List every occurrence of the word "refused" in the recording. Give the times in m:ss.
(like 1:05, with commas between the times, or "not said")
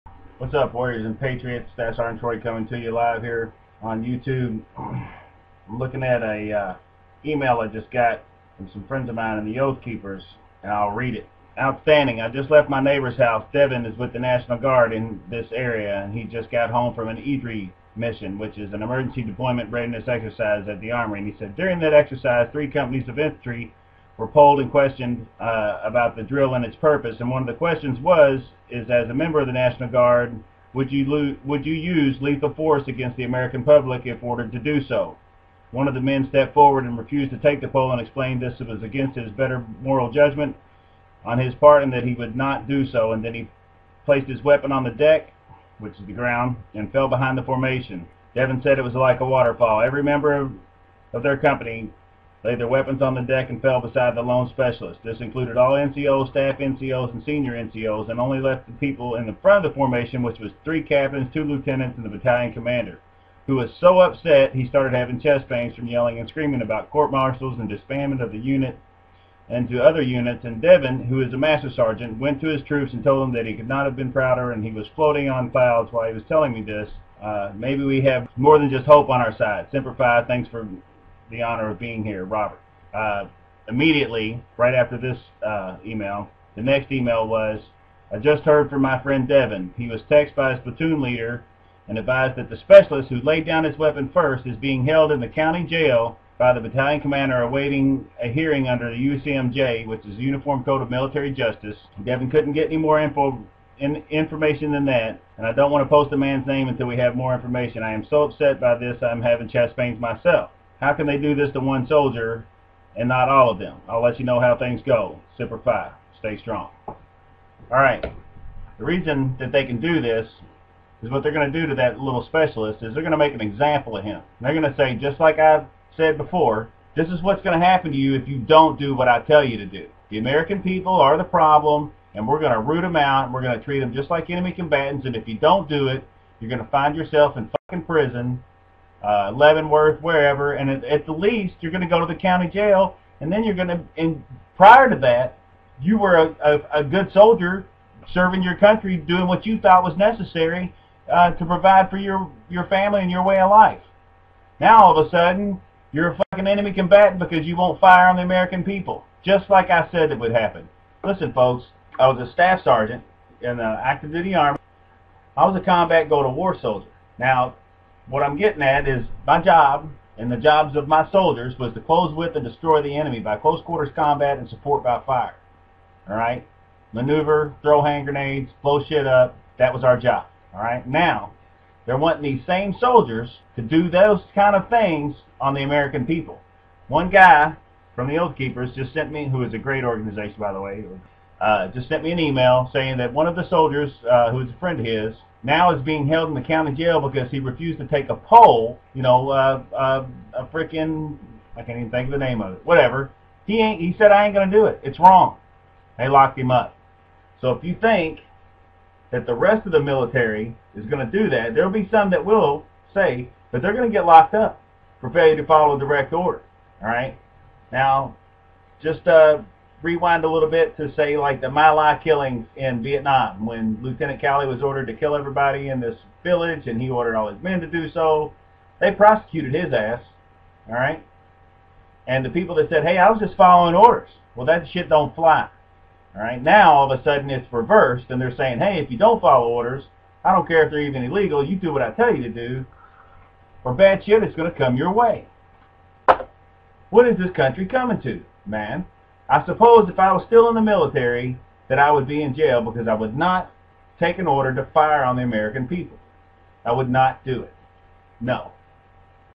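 0:36, 3:17.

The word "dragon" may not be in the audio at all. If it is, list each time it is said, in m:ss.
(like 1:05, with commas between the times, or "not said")
not said.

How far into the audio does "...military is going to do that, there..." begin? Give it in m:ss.
3:29.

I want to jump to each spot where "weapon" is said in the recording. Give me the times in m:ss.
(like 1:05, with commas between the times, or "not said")
0:44, 0:52, 1:33.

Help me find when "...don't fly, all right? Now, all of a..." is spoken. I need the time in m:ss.
3:54.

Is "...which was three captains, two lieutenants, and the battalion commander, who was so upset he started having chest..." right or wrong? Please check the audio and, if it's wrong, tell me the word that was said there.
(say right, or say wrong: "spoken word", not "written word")
right.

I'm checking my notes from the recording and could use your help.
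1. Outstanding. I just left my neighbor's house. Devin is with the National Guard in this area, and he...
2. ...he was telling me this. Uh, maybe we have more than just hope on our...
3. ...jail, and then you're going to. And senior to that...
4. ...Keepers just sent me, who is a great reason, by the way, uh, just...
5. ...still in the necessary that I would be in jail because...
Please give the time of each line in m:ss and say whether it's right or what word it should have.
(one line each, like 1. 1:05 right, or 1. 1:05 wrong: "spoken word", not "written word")
1. 0:11 right
2. 1:16 right
3. 2:22 wrong: "prior", not "senior"
4. 3:08 wrong: "organization", not "reason"
5. 4:10 wrong: "military", not "necessary".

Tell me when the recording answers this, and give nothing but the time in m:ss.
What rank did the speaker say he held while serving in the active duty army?
2:42.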